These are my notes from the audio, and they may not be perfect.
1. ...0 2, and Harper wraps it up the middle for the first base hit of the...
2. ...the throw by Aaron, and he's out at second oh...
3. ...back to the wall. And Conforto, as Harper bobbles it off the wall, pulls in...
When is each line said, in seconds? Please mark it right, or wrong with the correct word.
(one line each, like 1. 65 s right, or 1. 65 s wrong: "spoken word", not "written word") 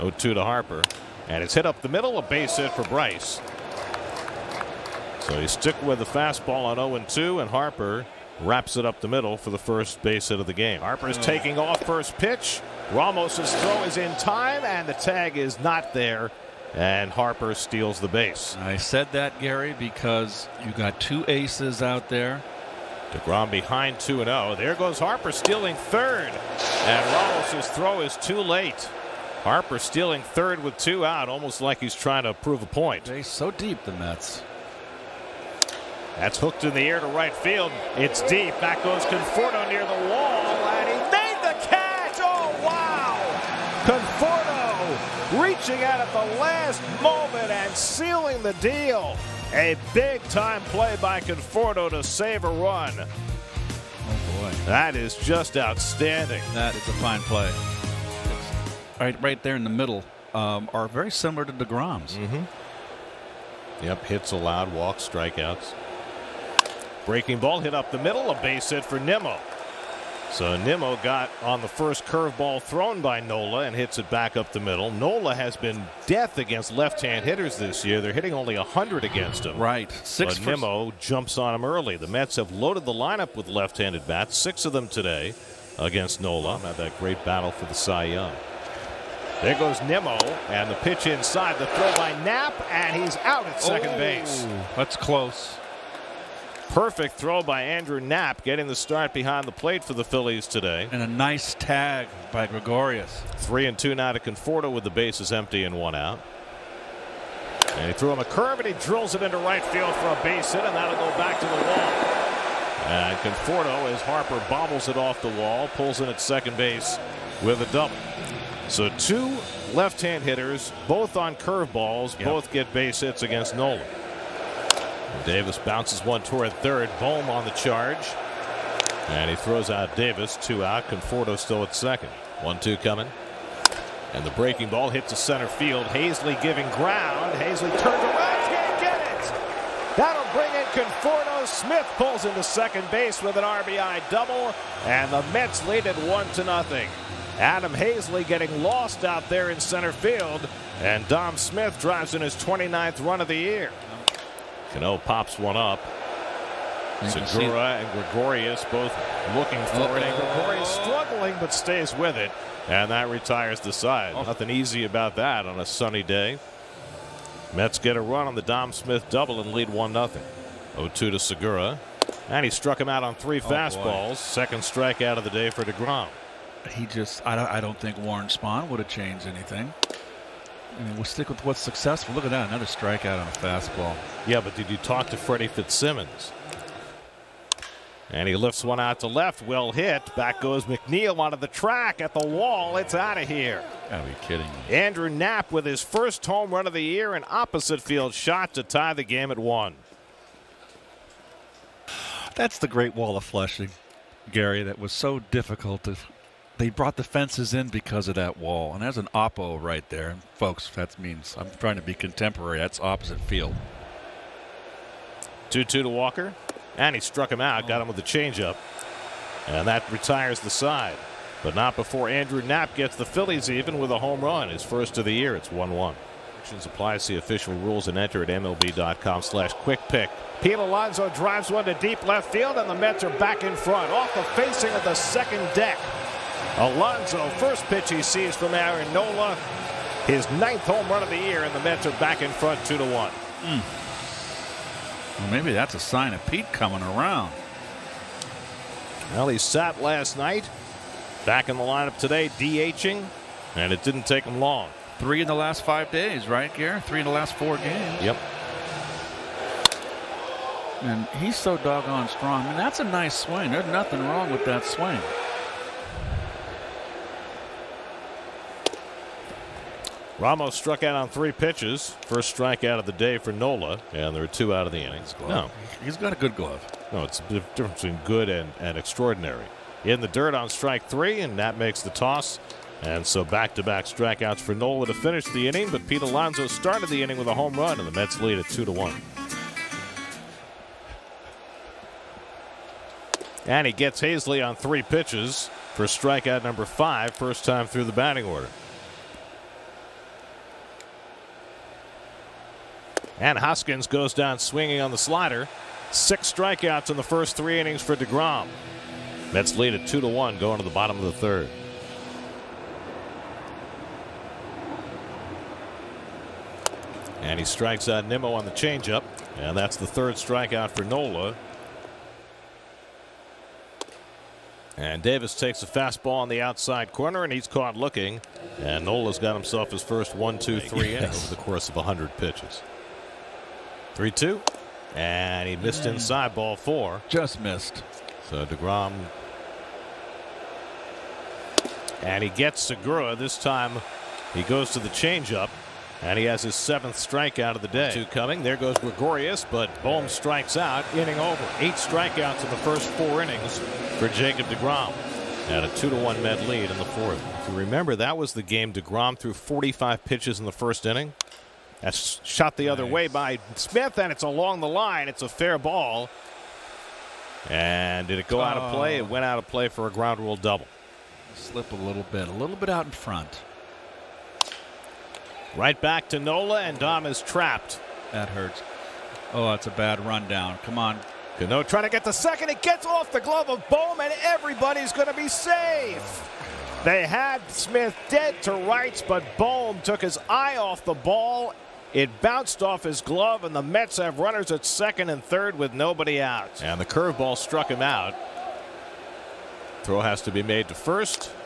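1. 6 s right
2. 91 s wrong: "Knapp", not "Aaron"
3. 111 s right.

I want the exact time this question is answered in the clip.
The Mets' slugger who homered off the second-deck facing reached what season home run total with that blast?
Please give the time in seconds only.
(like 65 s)
240 s.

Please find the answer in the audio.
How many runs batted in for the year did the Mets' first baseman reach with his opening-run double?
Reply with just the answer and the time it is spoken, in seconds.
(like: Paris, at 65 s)
29, at 152 s.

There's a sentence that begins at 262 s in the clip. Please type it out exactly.
I mean, that's a nice swing.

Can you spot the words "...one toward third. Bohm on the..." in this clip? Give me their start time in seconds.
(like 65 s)
126 s.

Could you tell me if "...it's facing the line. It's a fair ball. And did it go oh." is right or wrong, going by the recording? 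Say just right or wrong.
wrong.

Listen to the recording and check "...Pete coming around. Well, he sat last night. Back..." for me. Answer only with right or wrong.
right.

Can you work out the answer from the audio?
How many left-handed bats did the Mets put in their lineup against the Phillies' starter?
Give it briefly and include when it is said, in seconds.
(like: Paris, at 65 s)
6, at 84 s.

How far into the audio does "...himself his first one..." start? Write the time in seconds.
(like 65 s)
329 s.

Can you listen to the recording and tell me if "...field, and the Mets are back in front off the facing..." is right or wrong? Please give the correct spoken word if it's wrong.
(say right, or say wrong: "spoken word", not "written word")
right.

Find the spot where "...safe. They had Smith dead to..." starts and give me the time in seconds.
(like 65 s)
385 s.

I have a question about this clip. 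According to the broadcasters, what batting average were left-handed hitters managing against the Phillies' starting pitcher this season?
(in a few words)
100.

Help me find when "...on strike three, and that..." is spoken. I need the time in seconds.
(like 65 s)
280 s.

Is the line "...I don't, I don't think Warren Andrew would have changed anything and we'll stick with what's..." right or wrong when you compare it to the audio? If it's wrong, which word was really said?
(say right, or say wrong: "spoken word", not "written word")
wrong: "Spahn", not "Andrew".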